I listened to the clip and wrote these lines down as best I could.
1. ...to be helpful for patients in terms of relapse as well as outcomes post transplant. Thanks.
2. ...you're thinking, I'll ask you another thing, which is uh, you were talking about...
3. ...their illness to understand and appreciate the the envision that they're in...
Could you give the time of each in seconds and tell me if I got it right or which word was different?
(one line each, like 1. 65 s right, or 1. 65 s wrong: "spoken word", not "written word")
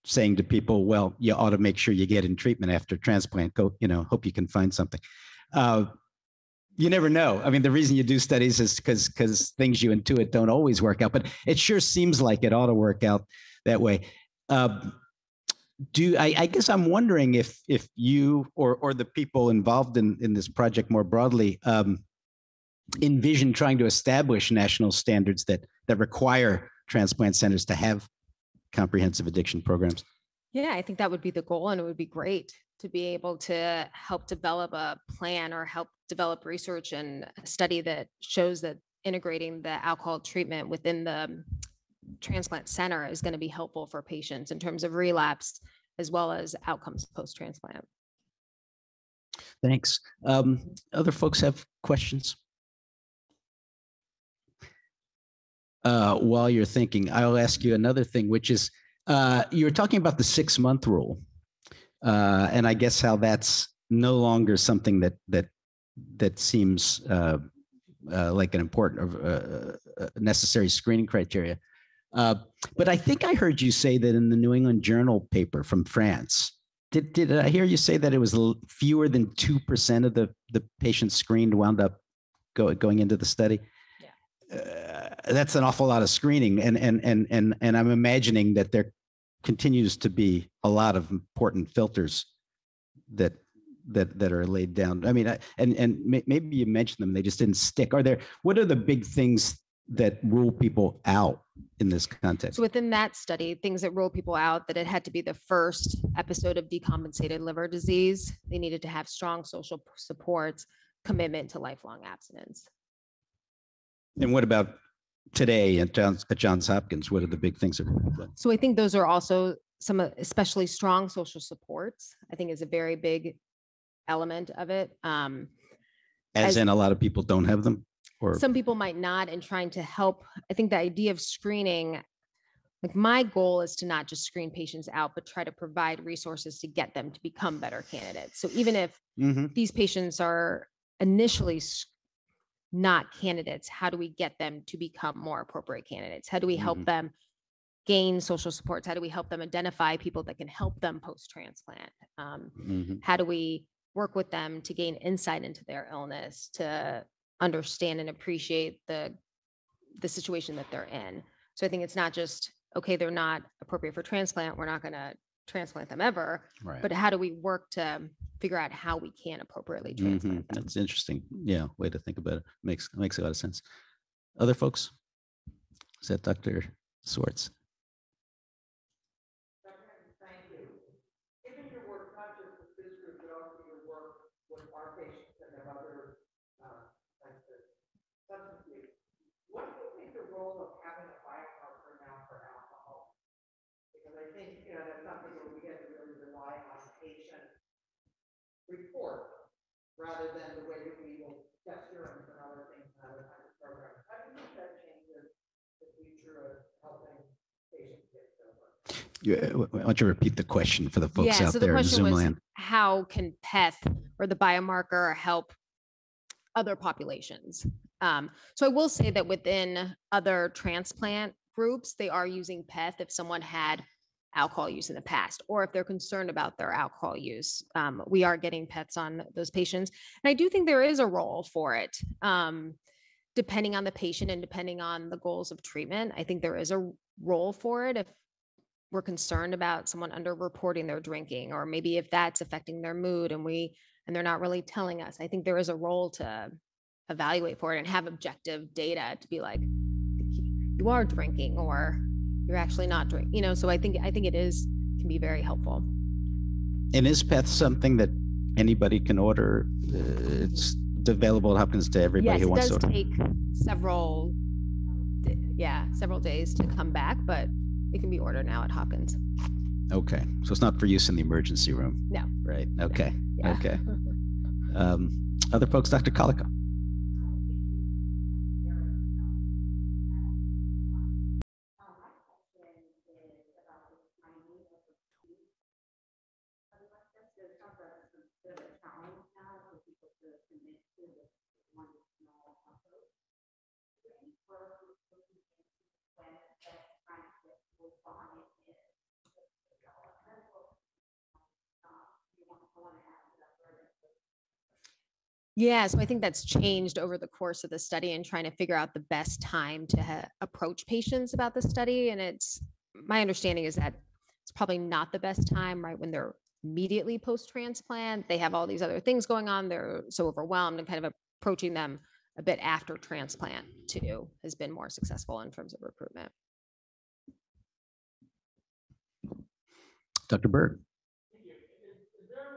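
1. 43 s right
2. 56 s right
3. 155 s wrong: "situation", not "envision".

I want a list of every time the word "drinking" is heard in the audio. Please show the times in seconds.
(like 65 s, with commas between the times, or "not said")
241 s, 251 s.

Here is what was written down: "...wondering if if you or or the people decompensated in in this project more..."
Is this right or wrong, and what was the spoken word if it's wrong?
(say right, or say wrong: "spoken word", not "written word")
wrong: "involved", not "decompensated".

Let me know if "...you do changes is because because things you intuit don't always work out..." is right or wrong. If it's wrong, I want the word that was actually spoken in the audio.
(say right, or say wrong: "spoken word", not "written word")
wrong: "studies", not "changes".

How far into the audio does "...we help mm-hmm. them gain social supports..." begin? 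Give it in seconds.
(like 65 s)
146 s.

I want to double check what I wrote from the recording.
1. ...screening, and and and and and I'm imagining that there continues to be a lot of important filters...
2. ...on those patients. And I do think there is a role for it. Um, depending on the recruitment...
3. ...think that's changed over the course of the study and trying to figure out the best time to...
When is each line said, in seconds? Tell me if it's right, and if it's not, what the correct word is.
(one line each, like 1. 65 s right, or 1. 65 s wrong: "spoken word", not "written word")
1. 86 s right
2. 228 s wrong: "patient", not "recruitment"
3. 306 s right.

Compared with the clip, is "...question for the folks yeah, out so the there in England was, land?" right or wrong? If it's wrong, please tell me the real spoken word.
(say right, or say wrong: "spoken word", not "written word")
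wrong: "Zoom", not "England".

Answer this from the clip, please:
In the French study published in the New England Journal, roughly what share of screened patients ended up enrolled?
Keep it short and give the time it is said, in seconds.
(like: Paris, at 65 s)
fewer than 2 percent, at 78 s.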